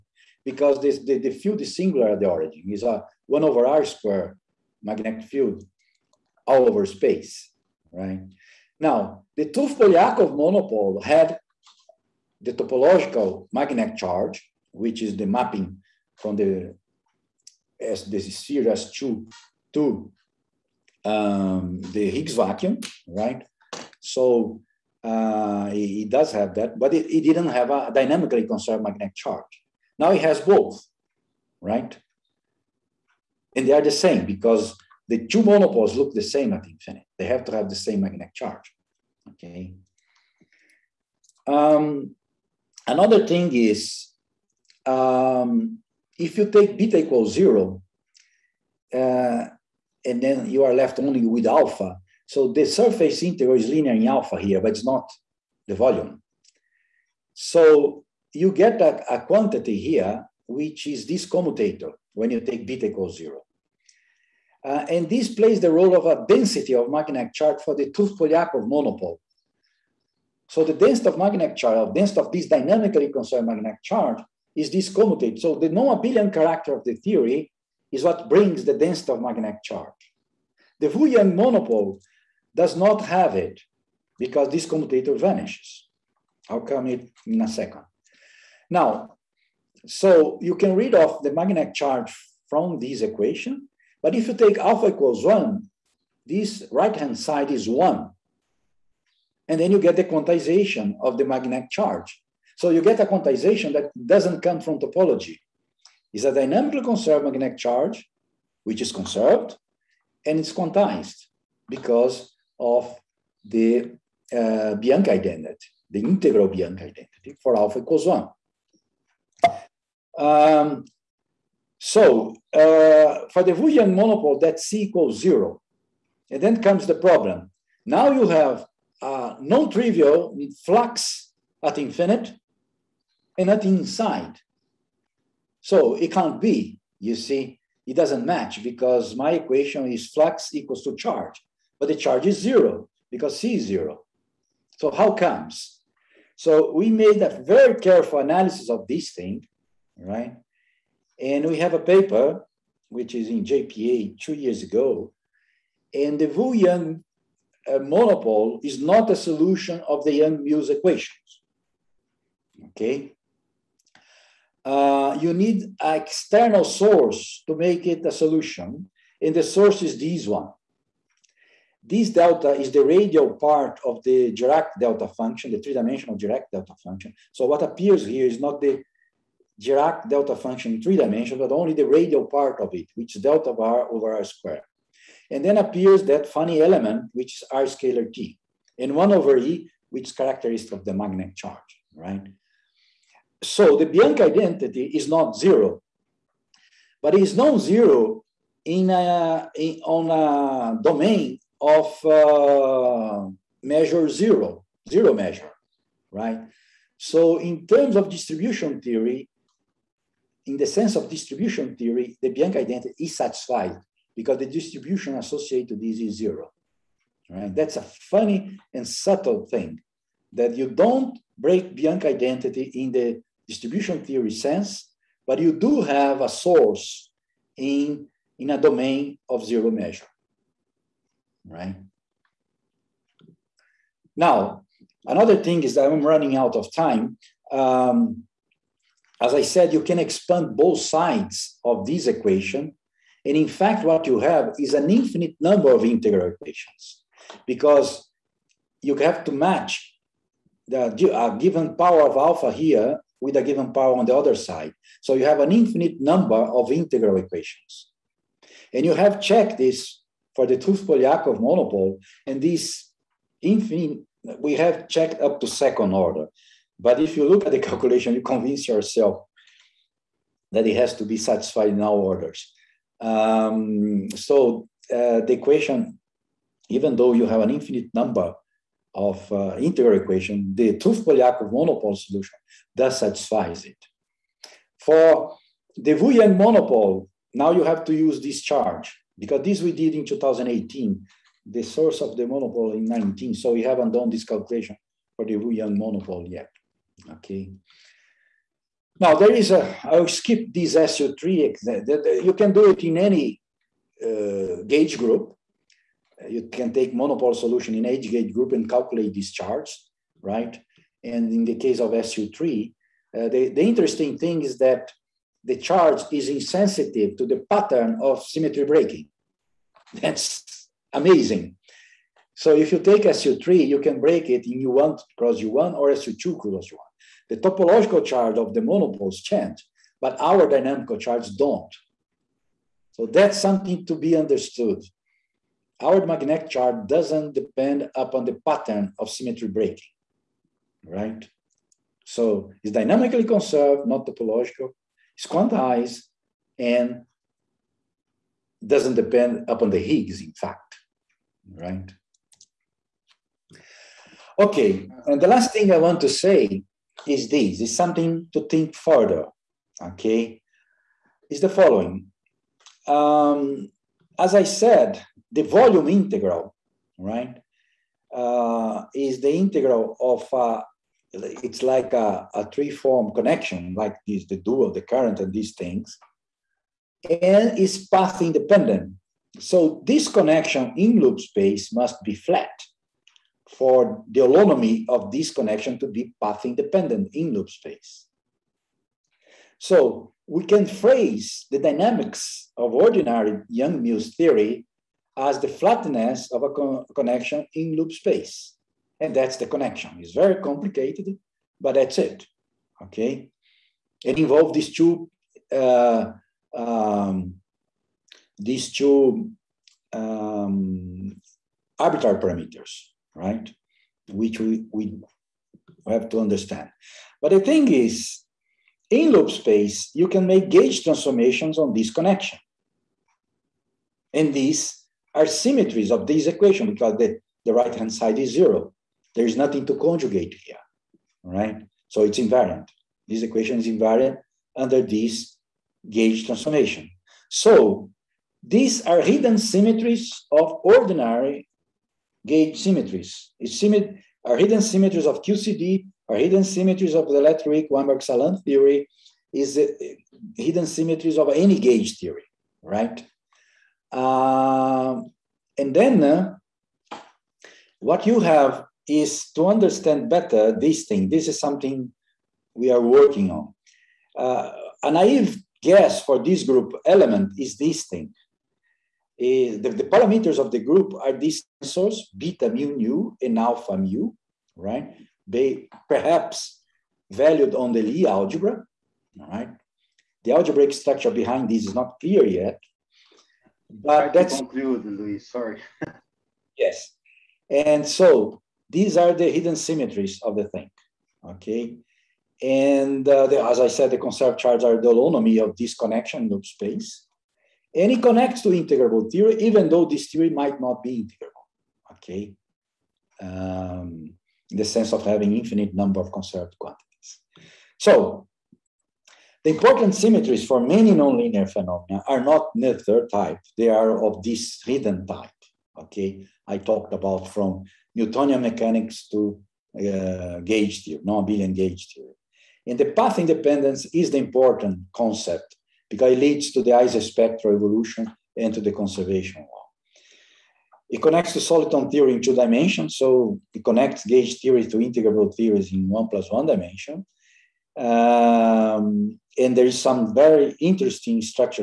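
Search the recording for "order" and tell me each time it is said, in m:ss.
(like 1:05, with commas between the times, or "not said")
4:25, 4:31.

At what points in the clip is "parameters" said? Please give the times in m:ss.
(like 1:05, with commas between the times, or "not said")
6:52, 7:49.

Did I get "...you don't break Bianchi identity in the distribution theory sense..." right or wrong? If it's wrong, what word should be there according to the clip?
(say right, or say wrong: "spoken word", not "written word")
right.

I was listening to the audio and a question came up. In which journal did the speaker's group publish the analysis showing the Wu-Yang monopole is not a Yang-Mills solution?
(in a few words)
JPA.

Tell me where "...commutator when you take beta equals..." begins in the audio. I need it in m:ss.
1:01.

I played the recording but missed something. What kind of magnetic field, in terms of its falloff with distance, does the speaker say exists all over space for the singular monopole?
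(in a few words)
1 over r squared.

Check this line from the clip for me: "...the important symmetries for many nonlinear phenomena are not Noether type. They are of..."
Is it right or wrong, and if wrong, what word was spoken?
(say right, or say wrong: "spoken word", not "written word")
right.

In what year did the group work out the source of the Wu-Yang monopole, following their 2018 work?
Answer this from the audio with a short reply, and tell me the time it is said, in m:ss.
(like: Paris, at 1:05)
2019, at 4:52.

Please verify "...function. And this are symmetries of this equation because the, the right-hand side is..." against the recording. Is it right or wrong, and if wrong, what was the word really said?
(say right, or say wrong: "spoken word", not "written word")
wrong: "connection", not "function".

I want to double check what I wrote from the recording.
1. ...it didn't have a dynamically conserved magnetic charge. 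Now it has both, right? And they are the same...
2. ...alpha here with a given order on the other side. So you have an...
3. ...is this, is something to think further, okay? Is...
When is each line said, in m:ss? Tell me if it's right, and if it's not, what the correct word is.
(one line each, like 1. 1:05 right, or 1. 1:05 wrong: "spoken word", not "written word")
1. 0:27 right
2. 4:12 wrong: "power", not "order"
3. 5:57 right.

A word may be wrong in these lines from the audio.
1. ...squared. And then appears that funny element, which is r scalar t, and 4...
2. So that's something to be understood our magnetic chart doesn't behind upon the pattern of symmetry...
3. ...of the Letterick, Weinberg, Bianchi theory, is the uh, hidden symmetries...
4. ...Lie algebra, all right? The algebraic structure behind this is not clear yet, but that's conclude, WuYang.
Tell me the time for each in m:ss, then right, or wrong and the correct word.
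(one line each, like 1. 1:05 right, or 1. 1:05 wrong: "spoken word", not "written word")
1. 3:04 wrong: "1", not "4"
2. 5:32 wrong: "depend", not "behind"
3. 7:26 wrong: "Salam", not "Bianchi"
4. 7:57 wrong: "Luiz", not "WuYang".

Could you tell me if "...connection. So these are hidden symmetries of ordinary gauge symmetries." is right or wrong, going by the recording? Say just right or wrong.
wrong.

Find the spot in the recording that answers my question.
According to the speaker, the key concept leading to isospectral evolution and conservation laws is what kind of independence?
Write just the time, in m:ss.
8:42.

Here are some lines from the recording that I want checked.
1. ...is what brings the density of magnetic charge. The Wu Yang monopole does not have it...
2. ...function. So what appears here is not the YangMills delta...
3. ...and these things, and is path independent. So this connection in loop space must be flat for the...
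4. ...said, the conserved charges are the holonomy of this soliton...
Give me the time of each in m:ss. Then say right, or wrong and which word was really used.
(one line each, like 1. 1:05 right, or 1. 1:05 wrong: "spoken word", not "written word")
1. 1:17 right
2. 2:56 wrong: "Dirac", not "YangMills"
3. 6:15 right
4. 8:13 wrong: "connection", not "soliton".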